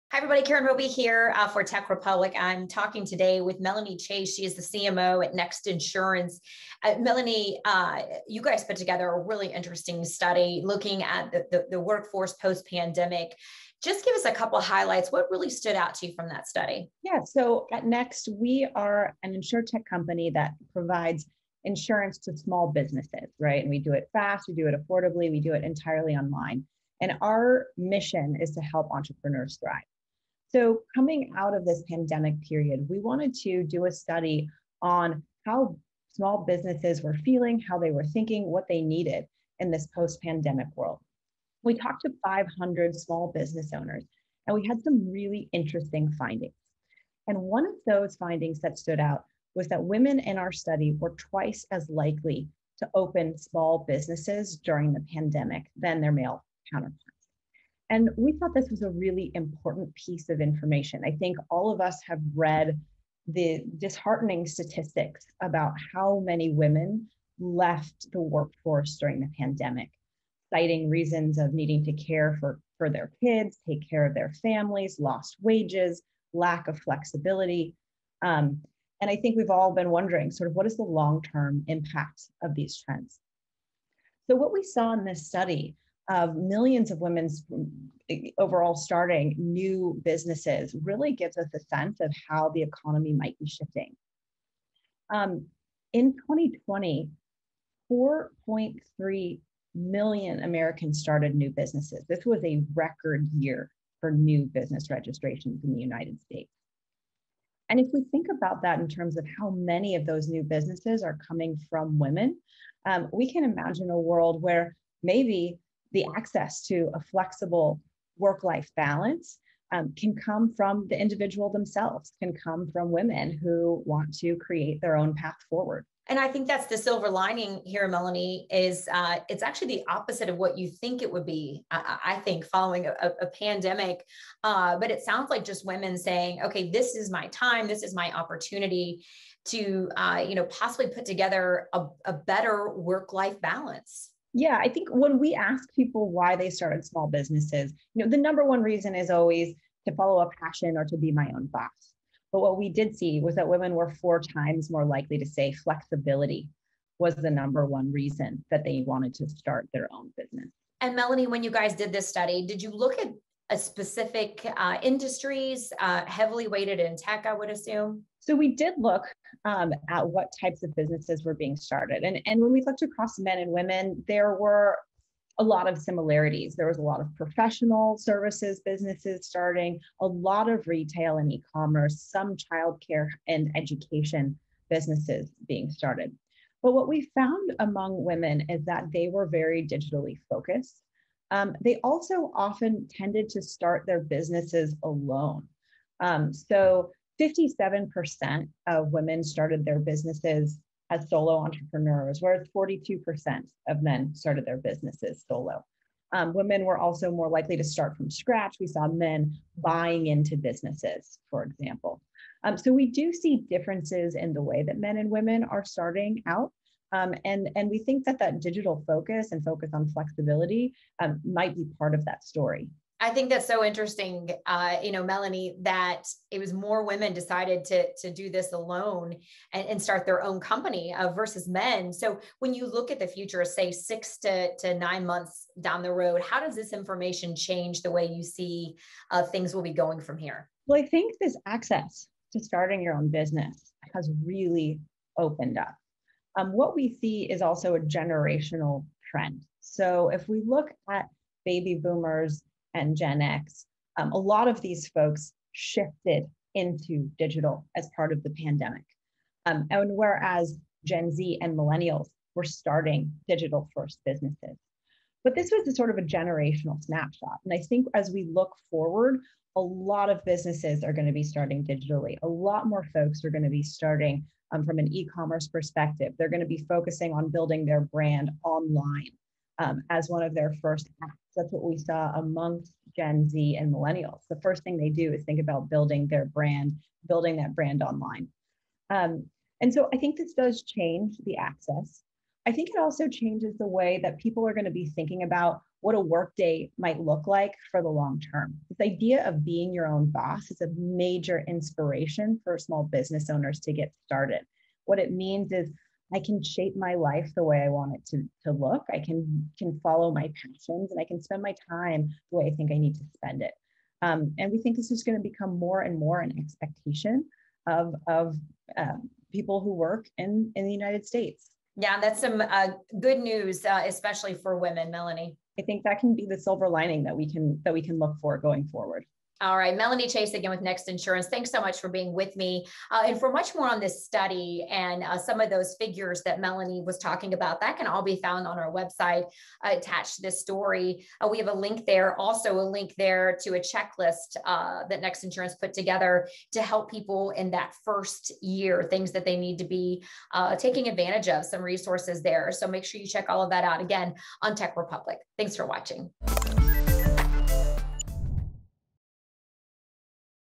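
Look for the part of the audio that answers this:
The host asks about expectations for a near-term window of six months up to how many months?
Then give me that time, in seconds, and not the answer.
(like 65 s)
234 s.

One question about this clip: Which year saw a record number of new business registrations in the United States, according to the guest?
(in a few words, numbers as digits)
2020.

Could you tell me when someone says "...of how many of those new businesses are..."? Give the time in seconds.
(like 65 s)
109 s.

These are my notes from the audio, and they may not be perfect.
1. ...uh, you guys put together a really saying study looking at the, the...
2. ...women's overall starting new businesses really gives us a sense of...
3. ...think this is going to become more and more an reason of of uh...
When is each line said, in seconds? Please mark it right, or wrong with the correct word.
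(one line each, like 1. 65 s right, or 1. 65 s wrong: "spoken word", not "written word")
1. 7 s wrong: "interesting", not "saying"
2. 87 s right
3. 314 s wrong: "expectation", not "reason".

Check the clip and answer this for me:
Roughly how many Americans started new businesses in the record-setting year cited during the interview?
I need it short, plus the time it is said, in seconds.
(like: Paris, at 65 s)
4.3 million, at 97 s.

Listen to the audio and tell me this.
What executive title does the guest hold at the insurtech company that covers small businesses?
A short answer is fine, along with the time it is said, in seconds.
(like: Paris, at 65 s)
CMO, at 4 s.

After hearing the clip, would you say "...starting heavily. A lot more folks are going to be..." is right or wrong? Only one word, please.
wrong.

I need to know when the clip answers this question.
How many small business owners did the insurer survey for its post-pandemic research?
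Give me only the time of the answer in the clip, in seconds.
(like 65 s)
42 s.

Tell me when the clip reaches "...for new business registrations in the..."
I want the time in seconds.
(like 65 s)
103 s.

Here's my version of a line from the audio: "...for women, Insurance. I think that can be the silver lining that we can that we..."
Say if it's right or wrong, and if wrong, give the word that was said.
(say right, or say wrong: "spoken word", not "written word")
wrong: "Melanie", not "Insurance".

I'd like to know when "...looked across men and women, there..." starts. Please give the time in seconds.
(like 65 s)
172 s.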